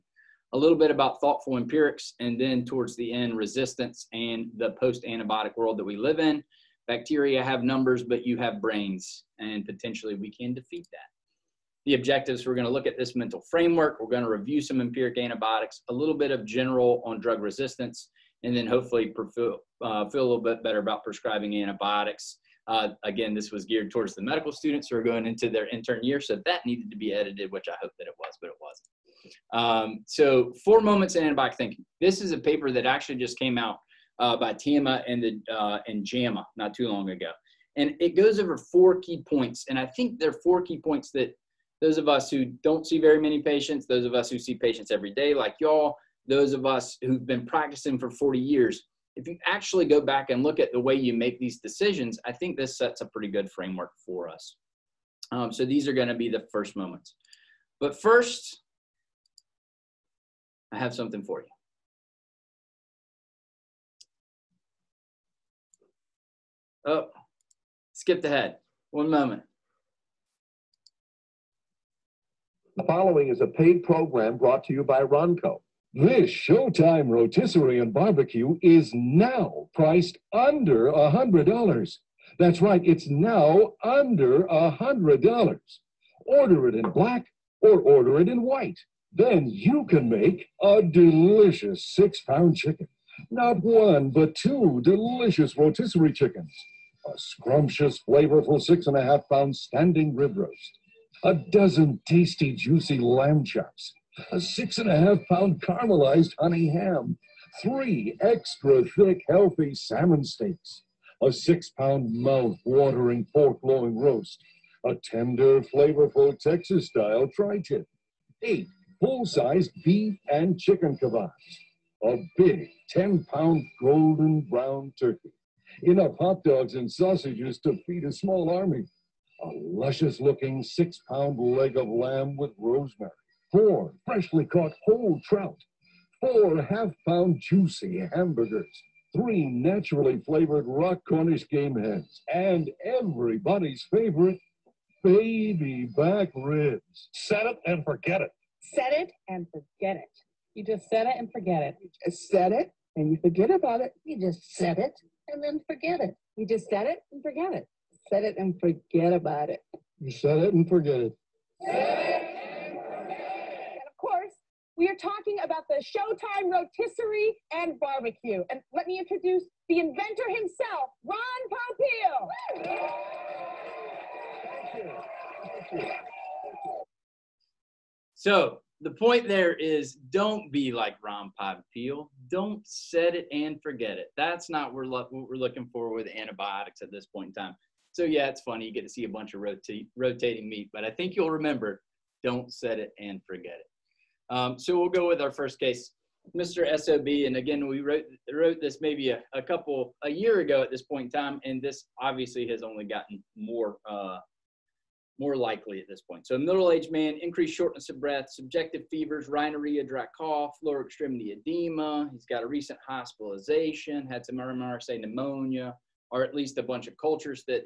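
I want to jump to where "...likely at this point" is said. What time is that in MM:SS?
03:25.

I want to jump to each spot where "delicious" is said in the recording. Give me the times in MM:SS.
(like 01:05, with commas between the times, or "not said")
01:30, 01:34.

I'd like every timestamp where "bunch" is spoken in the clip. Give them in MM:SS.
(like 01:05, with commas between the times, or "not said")
03:09, 03:36.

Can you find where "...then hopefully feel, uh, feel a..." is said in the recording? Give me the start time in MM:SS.
00:18.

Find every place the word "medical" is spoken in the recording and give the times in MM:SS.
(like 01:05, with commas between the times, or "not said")
00:24.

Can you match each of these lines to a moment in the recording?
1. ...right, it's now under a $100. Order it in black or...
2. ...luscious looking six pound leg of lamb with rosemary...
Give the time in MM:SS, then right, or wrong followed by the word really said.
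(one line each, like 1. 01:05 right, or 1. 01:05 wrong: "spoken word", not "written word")
1. 01:22 right
2. 02:09 right.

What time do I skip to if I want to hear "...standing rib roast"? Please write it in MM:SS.
01:39.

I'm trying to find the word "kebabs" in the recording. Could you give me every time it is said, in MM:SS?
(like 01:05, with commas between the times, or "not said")
02:01.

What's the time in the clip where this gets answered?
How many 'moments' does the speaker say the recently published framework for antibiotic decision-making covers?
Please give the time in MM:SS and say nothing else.
00:30.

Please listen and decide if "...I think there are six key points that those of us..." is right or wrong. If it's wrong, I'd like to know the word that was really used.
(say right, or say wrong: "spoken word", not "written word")
wrong: "four", not "six".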